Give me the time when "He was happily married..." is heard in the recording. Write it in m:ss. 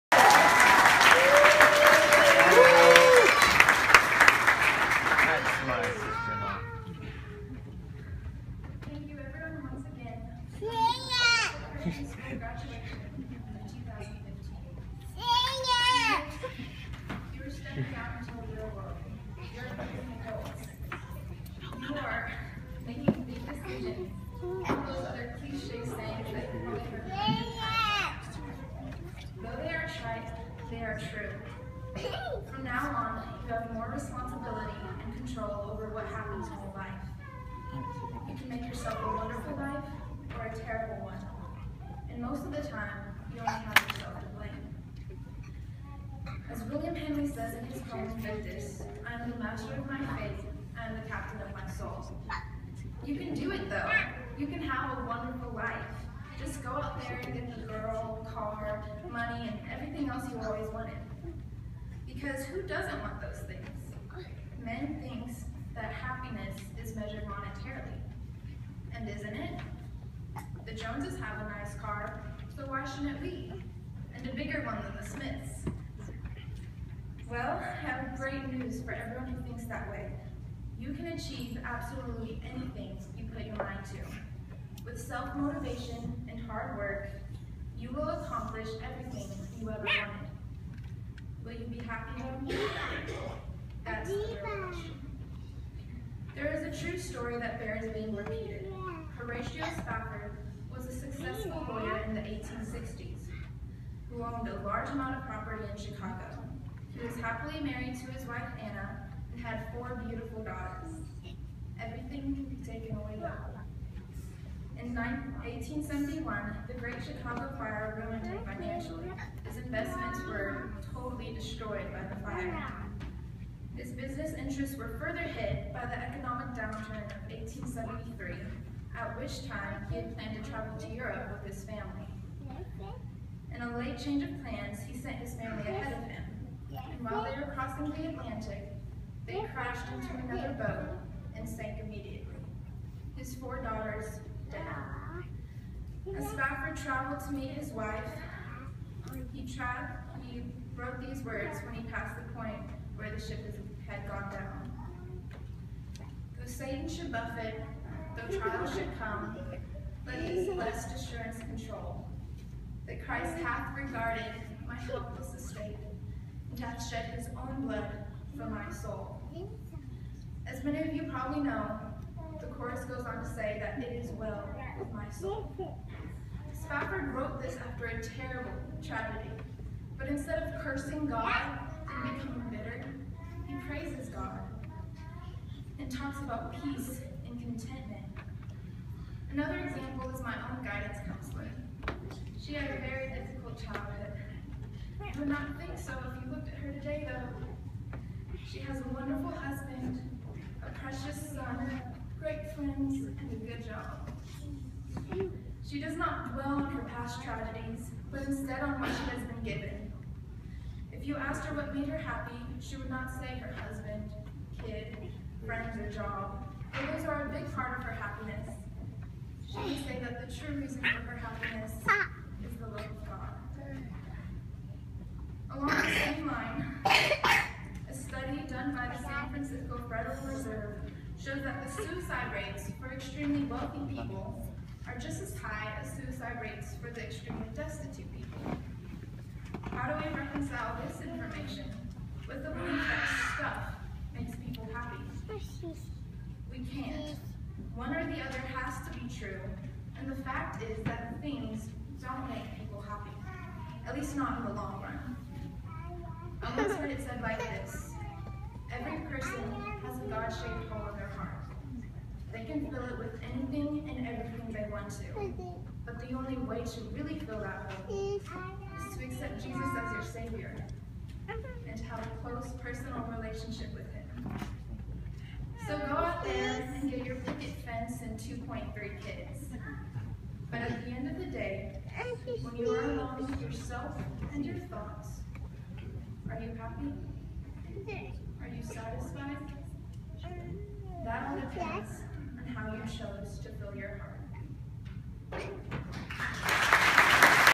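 1:46.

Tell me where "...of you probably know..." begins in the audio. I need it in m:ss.
2:50.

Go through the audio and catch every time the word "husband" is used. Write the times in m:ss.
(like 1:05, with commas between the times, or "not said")
3:19, 3:33.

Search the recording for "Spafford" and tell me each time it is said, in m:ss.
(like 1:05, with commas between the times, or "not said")
1:39, 2:26, 2:56.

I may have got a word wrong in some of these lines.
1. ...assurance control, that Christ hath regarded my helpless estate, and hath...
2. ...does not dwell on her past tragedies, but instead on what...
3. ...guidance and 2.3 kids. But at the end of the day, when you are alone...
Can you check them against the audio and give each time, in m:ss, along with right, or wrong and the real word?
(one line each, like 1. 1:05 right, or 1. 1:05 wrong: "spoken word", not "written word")
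1. 2:40 right
2. 3:25 right
3. 4:37 wrong: "fence", not "guidance".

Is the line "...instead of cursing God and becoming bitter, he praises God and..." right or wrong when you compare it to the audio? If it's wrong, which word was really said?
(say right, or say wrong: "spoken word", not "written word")
right.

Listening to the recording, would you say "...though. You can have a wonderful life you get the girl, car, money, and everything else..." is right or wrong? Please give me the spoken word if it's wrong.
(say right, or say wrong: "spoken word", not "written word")
right.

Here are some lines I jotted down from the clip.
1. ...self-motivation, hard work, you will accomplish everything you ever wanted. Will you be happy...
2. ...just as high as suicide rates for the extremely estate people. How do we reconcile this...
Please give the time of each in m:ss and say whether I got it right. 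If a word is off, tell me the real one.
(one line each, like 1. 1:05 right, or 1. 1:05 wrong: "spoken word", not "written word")
1. 1:25 right
2. 3:54 wrong: "destitute", not "estate".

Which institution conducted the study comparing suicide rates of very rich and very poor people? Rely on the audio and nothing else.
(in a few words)
San Francisco Federal Reserve.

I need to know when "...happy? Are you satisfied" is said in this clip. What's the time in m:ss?
4:46.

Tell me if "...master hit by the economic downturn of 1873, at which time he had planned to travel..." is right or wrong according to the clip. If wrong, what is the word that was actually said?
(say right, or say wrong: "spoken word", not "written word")
wrong: "further", not "master".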